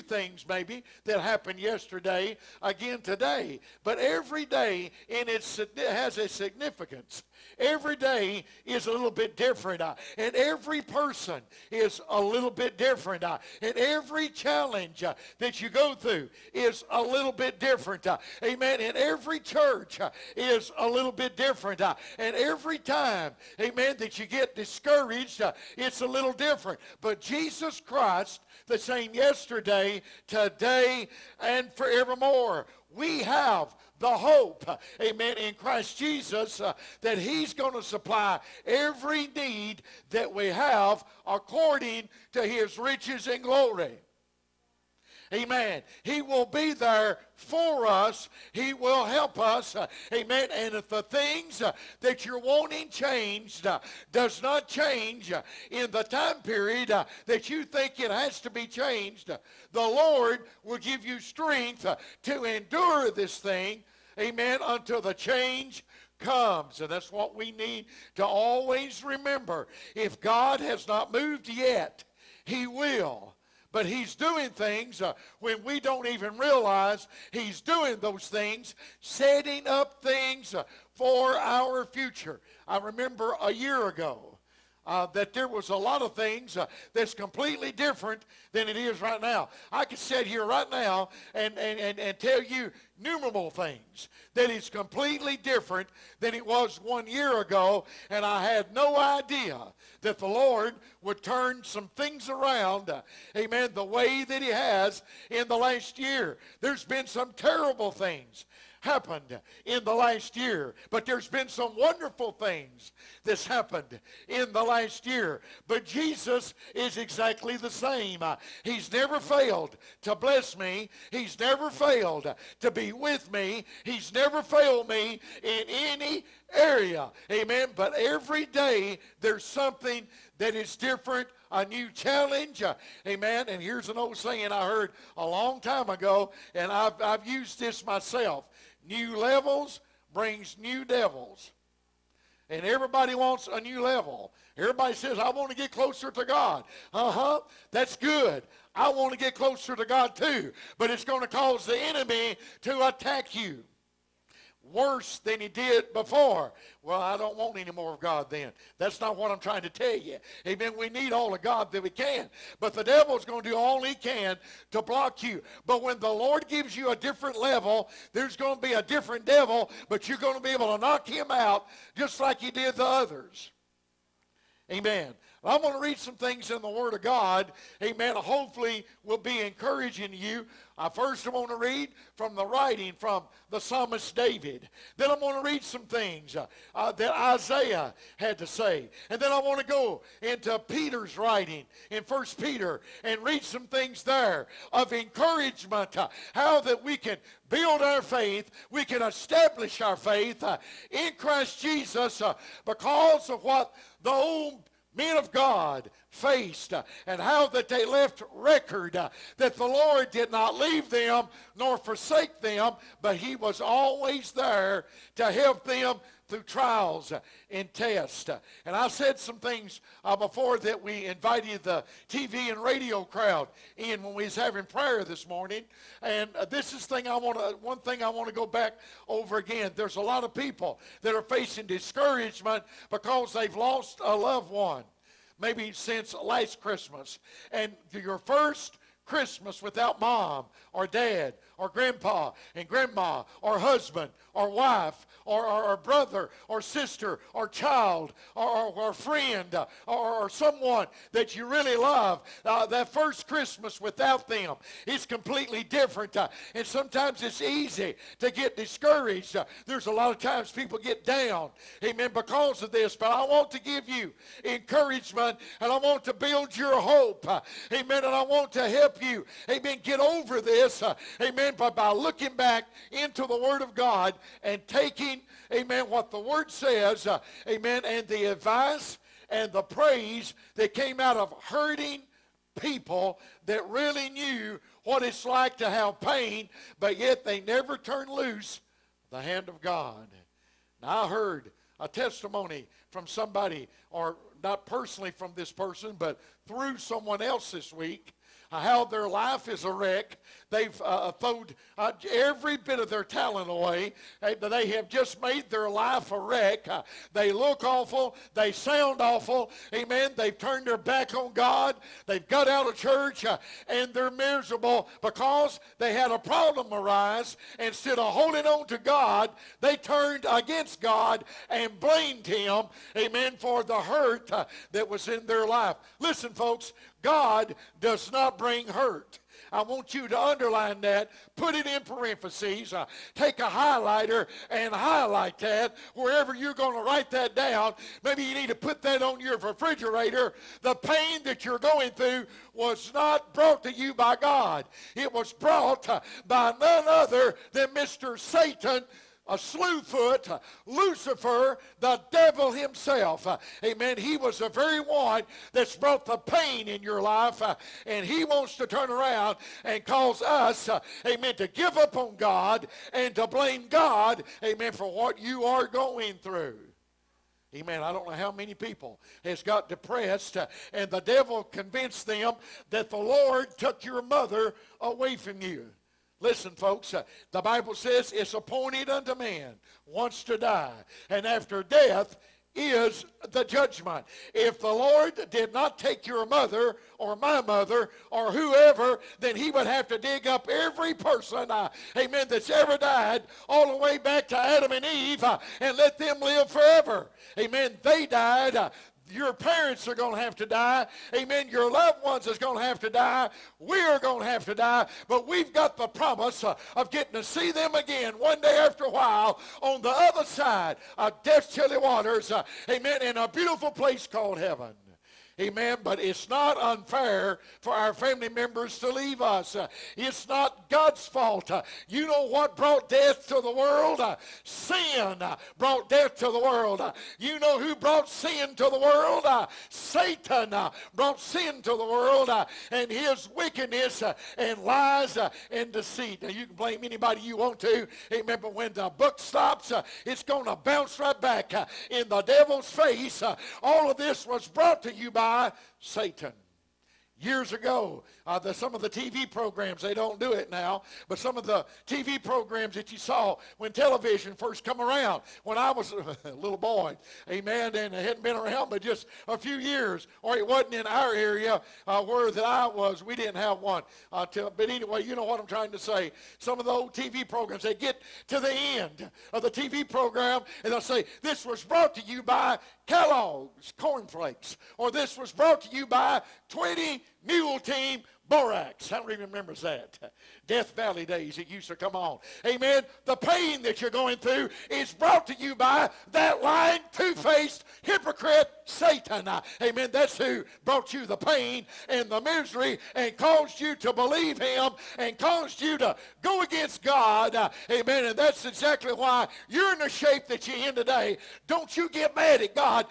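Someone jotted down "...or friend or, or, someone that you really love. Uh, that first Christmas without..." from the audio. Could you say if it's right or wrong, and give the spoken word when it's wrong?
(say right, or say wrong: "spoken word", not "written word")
right.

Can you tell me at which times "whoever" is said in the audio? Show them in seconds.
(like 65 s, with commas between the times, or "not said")
388 s.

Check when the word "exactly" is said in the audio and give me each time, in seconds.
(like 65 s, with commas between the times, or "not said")
116 s, 498 s.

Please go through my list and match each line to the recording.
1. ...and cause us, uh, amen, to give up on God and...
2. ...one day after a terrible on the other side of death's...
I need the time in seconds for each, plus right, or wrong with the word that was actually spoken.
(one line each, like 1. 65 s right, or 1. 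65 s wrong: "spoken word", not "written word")
1. 359 s right
2. 408 s wrong: "while", not "terrible".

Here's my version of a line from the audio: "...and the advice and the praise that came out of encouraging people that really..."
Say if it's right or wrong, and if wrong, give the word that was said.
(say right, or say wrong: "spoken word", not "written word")
wrong: "hurting", not "encouraging".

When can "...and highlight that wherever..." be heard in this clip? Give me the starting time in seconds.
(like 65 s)
334 s.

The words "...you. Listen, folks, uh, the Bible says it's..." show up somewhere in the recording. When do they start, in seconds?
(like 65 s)
375 s.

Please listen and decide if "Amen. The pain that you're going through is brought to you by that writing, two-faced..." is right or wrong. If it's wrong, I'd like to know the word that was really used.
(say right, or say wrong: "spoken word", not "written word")
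wrong: "lying", not "writing".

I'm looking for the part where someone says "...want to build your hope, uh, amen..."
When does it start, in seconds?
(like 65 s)
265 s.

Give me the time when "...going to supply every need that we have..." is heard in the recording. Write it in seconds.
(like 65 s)
37 s.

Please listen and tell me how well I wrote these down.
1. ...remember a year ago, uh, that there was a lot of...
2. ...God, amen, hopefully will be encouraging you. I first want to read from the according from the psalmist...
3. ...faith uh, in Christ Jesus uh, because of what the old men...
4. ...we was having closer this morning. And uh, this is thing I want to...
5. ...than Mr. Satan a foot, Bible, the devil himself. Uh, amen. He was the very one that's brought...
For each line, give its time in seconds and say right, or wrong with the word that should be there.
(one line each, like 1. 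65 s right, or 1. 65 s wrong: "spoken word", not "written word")
1. 82 s right
2. 177 s wrong: "writing", not "according"
3. 199 s right
4. 224 s wrong: "prayer", not "closer"
5. 347 s wrong: "Lucifer", not "Bible".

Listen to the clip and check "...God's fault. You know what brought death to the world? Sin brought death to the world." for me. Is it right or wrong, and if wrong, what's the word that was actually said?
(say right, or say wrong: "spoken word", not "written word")
right.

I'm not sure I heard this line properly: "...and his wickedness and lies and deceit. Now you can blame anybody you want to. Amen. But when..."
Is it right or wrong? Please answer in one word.
right.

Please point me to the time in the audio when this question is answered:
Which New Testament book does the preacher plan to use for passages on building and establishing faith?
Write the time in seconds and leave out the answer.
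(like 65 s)
192 s.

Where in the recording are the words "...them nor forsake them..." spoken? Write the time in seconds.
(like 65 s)
210 s.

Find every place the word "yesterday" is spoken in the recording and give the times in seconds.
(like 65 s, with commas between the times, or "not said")
1 s, 29 s.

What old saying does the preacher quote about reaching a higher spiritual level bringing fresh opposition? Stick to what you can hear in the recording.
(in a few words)
New levels brings new devils.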